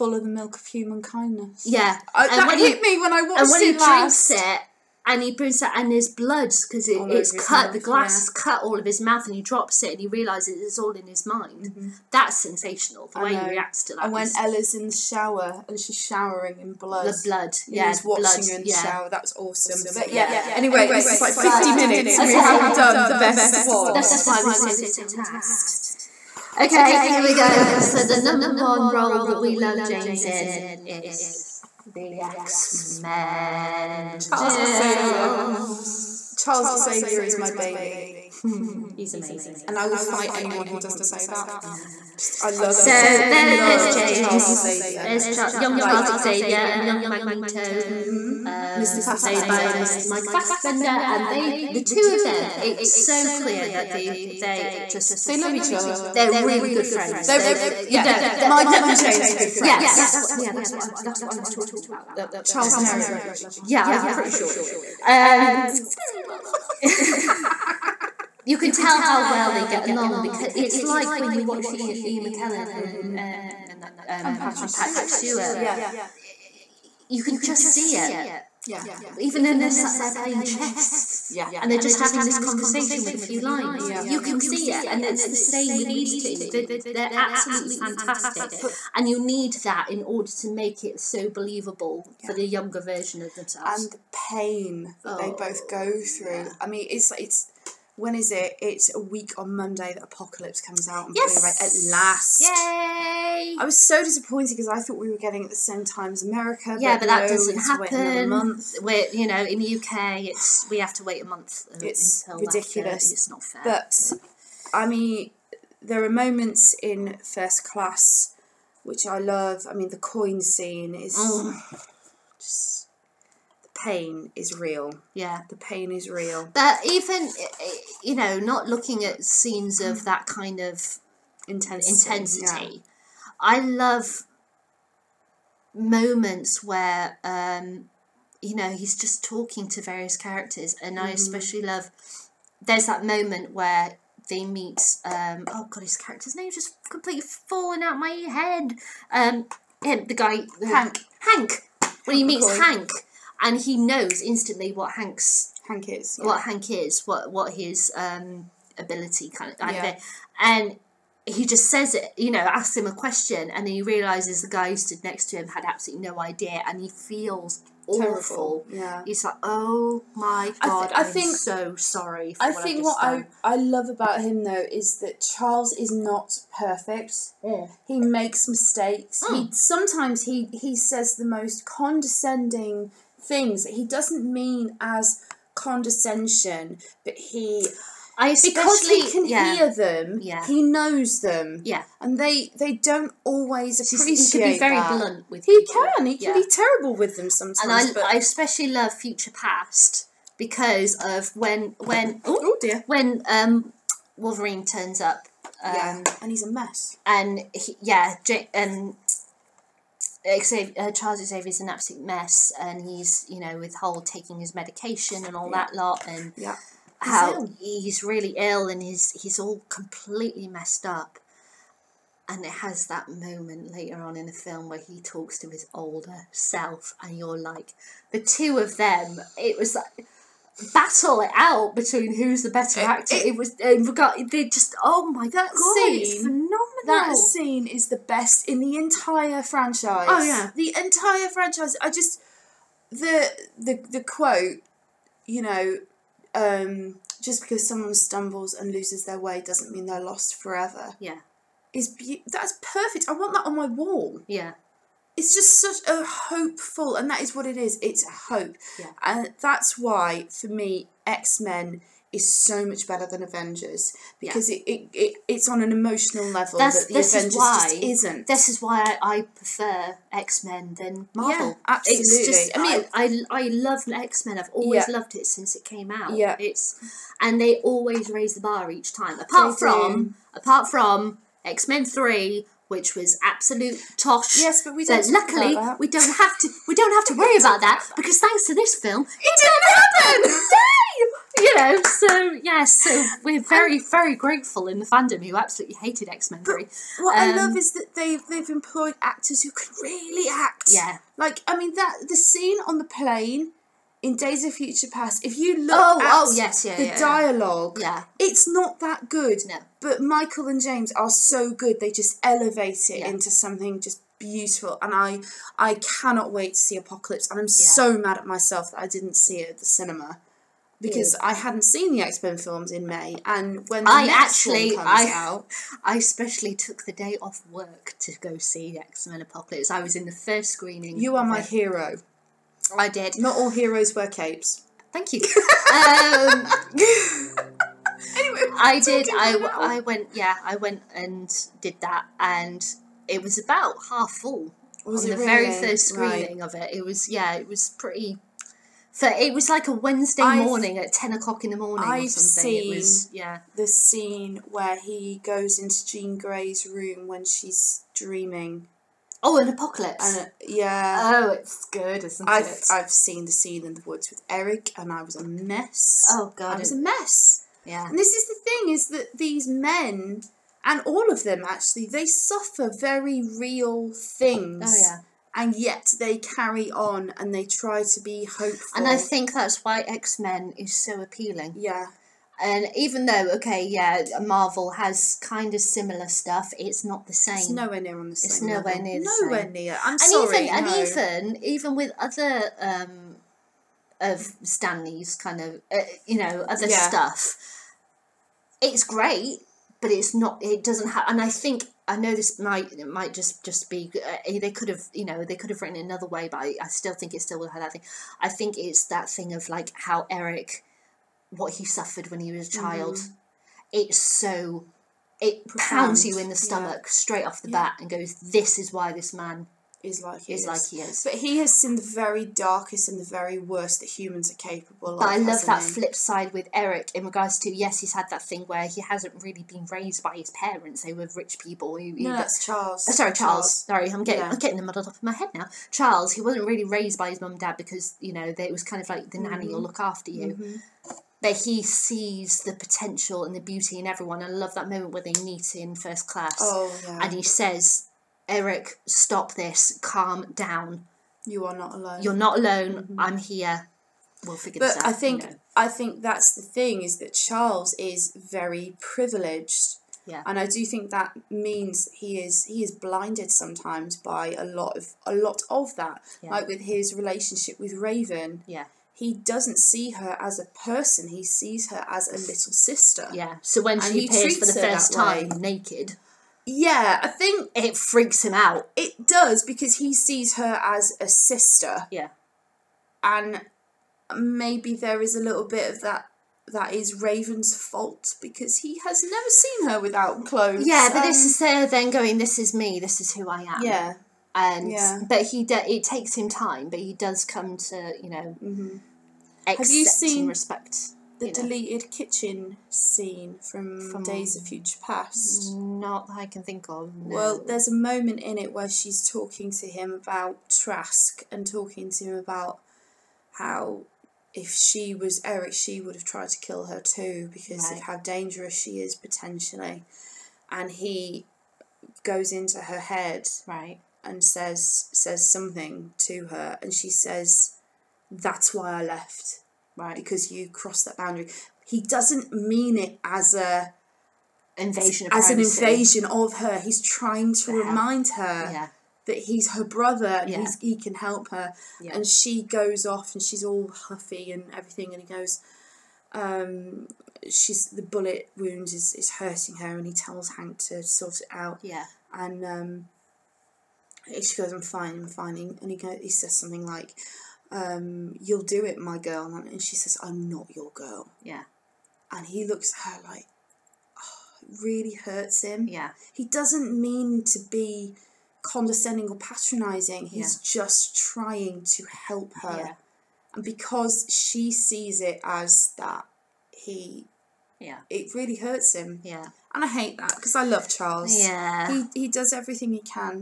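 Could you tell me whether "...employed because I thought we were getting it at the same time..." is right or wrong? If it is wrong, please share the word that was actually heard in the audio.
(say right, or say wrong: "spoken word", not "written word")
wrong: "disappointed", not "employed".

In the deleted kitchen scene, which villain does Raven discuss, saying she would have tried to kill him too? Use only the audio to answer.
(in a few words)
Trask.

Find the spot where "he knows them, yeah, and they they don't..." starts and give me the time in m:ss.
3:10.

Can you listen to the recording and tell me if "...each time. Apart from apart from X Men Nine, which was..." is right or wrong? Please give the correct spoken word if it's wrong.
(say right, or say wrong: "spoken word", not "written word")
wrong: "Three", not "Nine".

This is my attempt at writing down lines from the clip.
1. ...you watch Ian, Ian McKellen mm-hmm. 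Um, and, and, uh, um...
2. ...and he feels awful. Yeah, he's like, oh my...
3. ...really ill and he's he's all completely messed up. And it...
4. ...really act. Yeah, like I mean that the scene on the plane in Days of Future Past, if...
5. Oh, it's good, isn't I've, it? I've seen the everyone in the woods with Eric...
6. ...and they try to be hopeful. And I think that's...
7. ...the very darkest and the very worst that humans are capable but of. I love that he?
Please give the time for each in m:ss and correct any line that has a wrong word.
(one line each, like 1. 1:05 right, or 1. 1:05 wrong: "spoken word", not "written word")
1. 1:11 right
2. 2:46 right
3. 3:38 right
4. 4:59 right
5. 6:01 wrong: "scene", not "everyone"
6. 6:17 right
7. 7:01 right.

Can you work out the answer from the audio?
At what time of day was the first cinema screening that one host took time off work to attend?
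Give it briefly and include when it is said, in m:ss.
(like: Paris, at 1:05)
10 o'clock, at 5:50.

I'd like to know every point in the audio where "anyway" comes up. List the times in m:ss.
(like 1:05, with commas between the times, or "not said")
0:20, 5:38.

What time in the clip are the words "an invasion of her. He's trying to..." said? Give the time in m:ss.
8:55.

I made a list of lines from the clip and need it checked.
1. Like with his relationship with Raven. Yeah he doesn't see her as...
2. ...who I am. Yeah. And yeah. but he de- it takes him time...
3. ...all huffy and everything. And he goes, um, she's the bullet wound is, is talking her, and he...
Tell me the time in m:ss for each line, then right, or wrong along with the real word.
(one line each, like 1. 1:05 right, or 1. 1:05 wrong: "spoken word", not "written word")
1. 7:46 right
2. 8:13 right
3. 9:03 wrong: "hurting", not "talking".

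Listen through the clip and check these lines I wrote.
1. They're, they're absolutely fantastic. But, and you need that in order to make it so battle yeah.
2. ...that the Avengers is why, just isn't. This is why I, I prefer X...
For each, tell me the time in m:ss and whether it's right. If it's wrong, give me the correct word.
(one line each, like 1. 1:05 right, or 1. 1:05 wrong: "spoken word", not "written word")
1. 1:26 wrong: "believable", not "battle"
2. 4:26 right.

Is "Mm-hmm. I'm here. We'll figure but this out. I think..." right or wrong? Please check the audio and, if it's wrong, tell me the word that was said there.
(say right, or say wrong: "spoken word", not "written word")
right.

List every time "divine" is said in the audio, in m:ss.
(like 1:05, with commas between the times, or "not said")
not said.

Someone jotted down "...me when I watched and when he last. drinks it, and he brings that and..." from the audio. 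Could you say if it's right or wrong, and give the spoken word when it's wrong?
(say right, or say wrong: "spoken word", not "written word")
right.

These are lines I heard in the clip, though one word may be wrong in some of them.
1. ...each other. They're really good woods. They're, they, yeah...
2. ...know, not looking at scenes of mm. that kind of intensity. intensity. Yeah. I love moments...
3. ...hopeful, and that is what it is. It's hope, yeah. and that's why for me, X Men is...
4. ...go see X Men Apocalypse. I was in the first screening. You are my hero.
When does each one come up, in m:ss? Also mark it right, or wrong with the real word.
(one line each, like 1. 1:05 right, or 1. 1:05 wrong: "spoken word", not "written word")
1. 0:55 wrong: "friends", not "woods"
2. 2:08 right
3. 4:16 right
4. 5:28 right.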